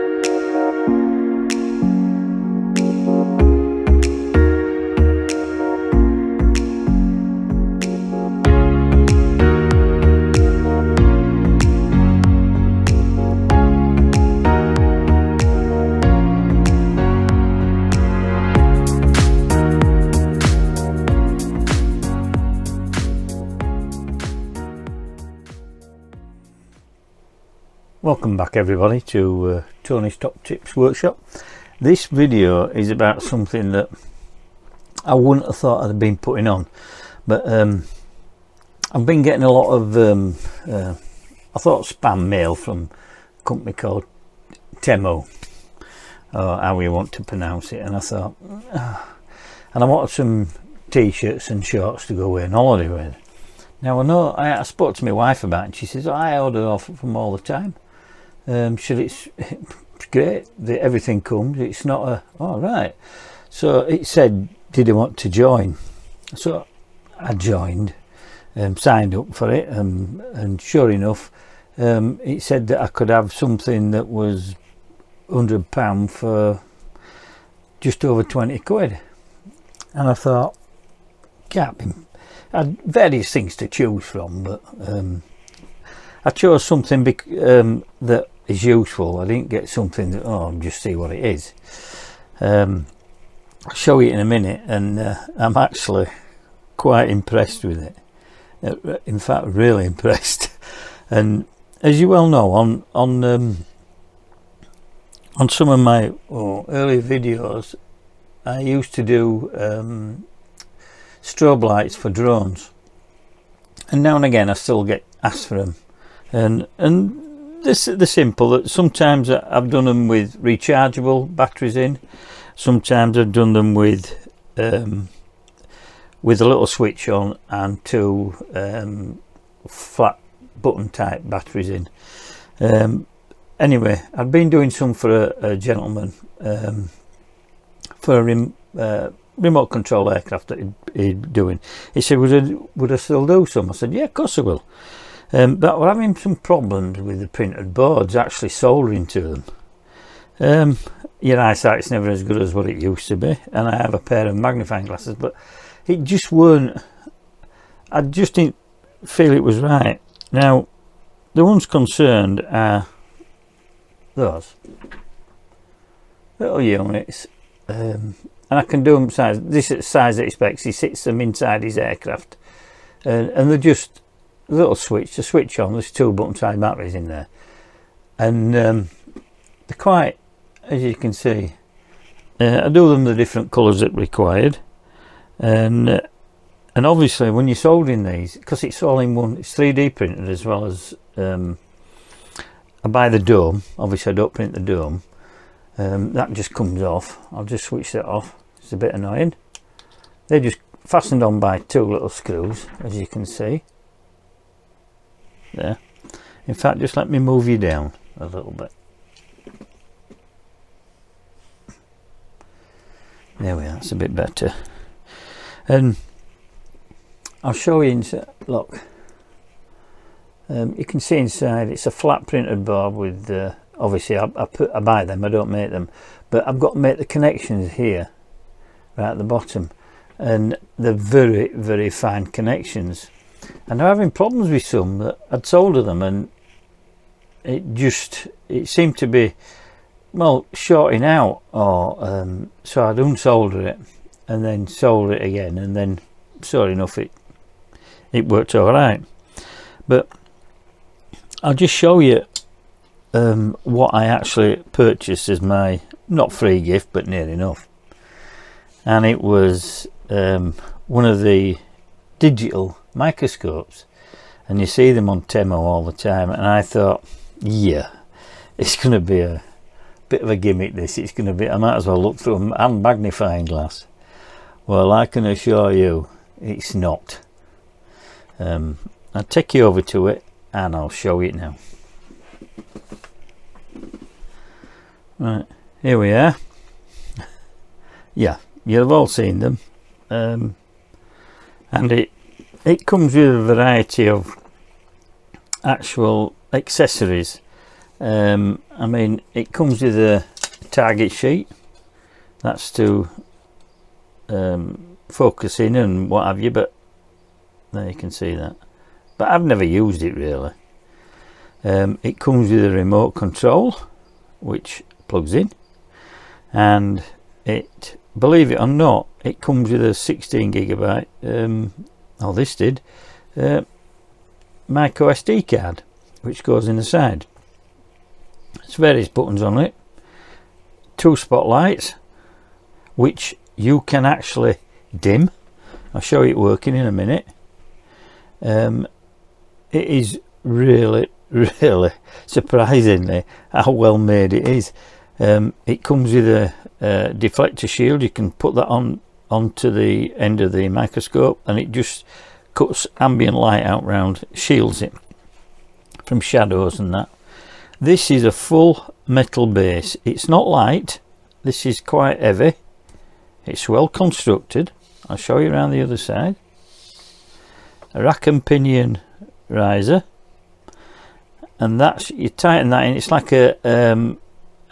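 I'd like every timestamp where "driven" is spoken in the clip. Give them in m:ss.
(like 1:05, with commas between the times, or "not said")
not said.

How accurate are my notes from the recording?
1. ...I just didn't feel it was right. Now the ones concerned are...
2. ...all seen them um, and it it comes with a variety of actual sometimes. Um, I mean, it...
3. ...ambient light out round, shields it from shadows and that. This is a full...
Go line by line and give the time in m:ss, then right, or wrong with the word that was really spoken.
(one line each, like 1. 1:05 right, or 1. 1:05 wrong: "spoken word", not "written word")
1. 2:37 right
2. 4:48 wrong: "accessories", not "sometimes"
3. 5:52 right.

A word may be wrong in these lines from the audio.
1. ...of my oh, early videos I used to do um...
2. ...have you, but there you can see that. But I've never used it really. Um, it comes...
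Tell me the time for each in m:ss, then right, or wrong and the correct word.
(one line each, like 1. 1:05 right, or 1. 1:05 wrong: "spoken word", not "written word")
1. 1:45 right
2. 5:06 right.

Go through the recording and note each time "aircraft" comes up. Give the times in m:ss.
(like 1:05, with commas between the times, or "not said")
2:20, 2:51.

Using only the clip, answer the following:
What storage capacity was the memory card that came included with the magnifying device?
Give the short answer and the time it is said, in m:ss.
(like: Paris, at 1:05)
16 gigabyte, at 5:19.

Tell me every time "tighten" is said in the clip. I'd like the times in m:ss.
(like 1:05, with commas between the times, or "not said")
6:12.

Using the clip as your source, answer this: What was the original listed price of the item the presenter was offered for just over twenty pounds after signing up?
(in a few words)
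£100.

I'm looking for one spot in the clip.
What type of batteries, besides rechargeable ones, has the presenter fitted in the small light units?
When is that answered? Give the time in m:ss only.
2:09.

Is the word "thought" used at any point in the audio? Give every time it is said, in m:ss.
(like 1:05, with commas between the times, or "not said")
0:35, 0:41, 0:47, 1:20, 4:26.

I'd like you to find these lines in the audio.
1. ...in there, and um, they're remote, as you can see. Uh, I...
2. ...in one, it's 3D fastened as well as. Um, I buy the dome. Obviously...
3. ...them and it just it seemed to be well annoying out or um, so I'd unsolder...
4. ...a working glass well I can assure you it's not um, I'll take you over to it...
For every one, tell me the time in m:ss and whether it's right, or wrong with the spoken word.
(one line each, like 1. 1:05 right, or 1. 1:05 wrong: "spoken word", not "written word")
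1. 2:56 wrong: "quite", not "remote"
2. 3:08 wrong: "printed", not "fastened"
3. 3:55 wrong: "shorting", not "annoying"
4. 4:32 wrong: "magnifying", not "working".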